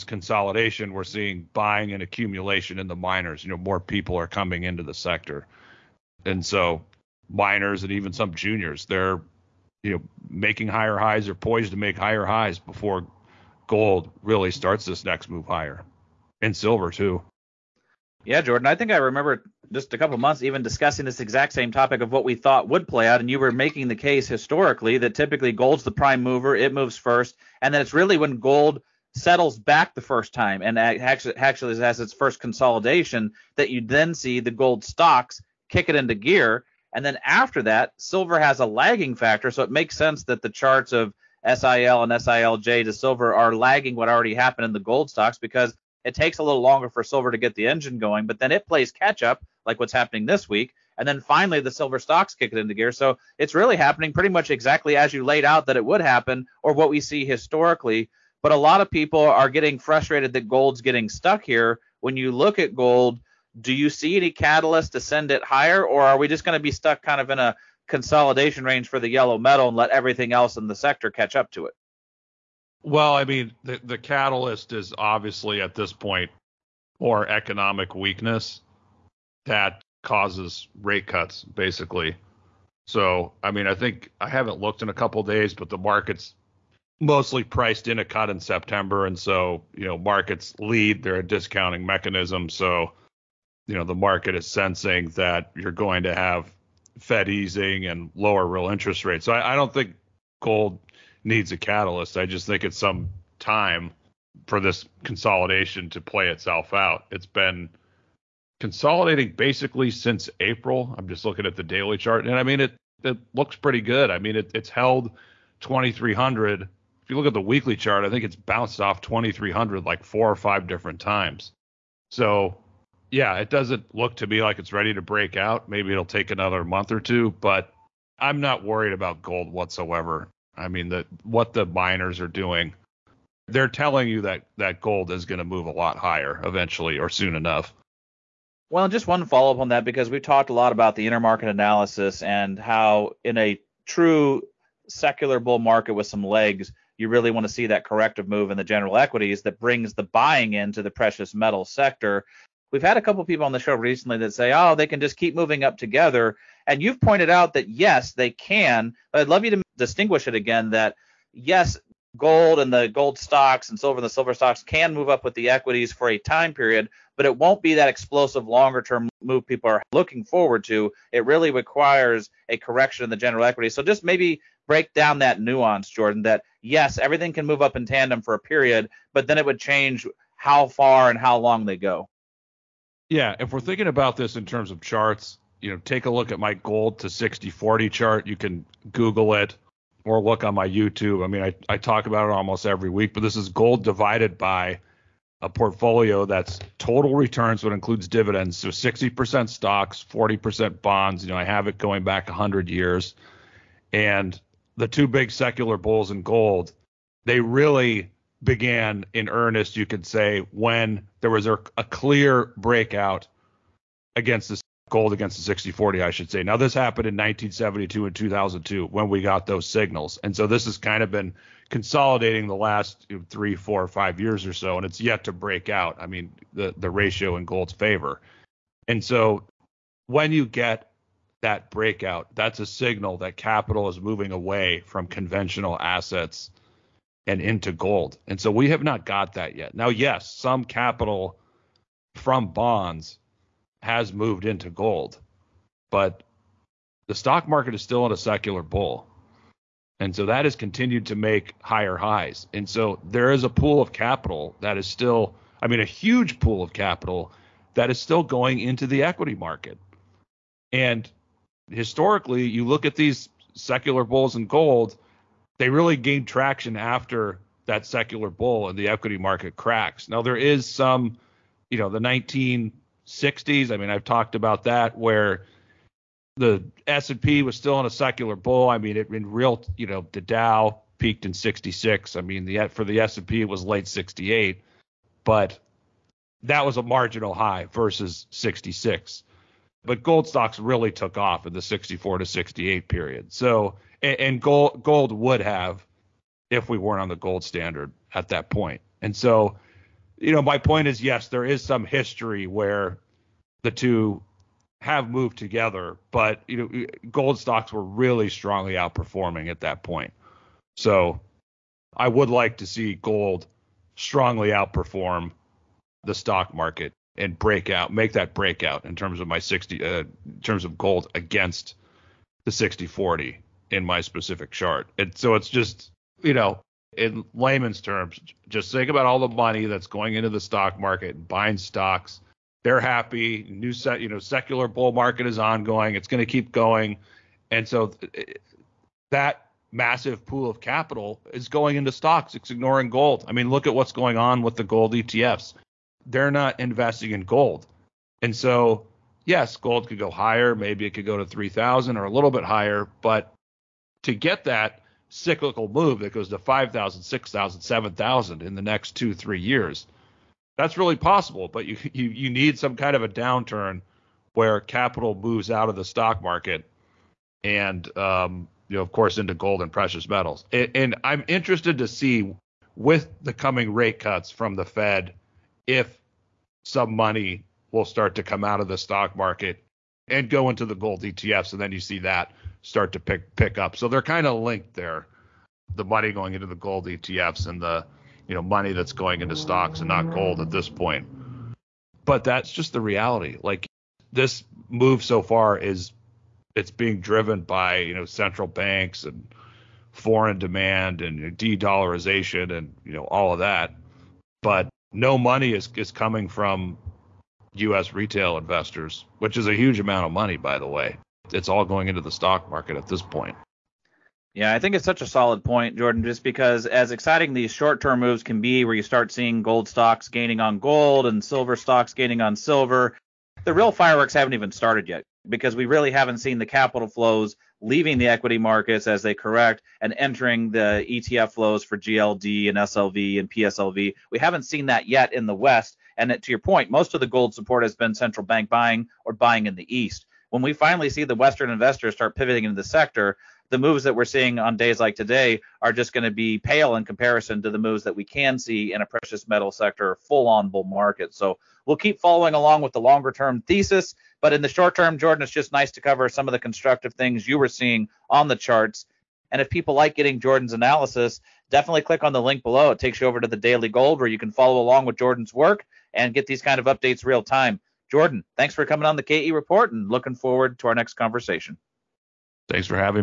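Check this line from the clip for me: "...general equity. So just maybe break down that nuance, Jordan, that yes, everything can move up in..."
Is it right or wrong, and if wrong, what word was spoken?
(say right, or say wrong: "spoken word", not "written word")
right.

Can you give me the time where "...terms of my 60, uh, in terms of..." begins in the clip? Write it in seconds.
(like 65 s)
318 s.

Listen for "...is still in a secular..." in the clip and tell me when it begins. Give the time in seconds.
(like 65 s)
247 s.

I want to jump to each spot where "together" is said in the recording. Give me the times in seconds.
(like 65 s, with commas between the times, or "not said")
155 s, 305 s.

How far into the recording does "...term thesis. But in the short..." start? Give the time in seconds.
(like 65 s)
453 s.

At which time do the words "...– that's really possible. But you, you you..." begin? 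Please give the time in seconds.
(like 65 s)
359 s.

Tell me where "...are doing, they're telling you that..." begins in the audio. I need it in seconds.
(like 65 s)
132 s.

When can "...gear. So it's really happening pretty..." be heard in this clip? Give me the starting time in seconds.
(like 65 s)
52 s.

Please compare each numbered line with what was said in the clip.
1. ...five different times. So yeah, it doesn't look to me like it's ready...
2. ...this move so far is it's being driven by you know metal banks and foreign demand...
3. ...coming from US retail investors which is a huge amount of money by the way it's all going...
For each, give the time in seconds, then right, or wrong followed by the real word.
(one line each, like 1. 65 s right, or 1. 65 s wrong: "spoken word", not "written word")
1. 120 s right
2. 394 s wrong: "central", not "metal"
3. 405 s right.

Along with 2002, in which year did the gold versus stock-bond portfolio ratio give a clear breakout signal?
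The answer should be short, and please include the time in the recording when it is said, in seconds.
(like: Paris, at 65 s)
1972, at 217 s.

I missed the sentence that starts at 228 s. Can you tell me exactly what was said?
And so when you get that breakout, that's a signal that capital is moving away from conventional assets and into gold.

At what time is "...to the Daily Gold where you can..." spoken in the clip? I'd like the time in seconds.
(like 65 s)
463 s.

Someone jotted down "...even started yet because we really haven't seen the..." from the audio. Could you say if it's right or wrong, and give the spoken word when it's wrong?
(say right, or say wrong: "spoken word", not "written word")
right.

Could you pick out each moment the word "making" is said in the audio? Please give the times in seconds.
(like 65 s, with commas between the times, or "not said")
10 s, 23 s.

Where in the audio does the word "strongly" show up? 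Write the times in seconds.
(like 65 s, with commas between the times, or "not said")
308 s, 313 s.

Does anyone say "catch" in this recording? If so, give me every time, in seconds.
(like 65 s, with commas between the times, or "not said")
48 s, 71 s.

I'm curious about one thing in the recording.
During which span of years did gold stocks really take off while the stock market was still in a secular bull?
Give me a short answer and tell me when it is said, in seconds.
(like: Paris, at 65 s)
1964 to 1968, at 291 s.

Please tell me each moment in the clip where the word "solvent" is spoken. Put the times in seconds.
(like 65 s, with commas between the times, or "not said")
not said.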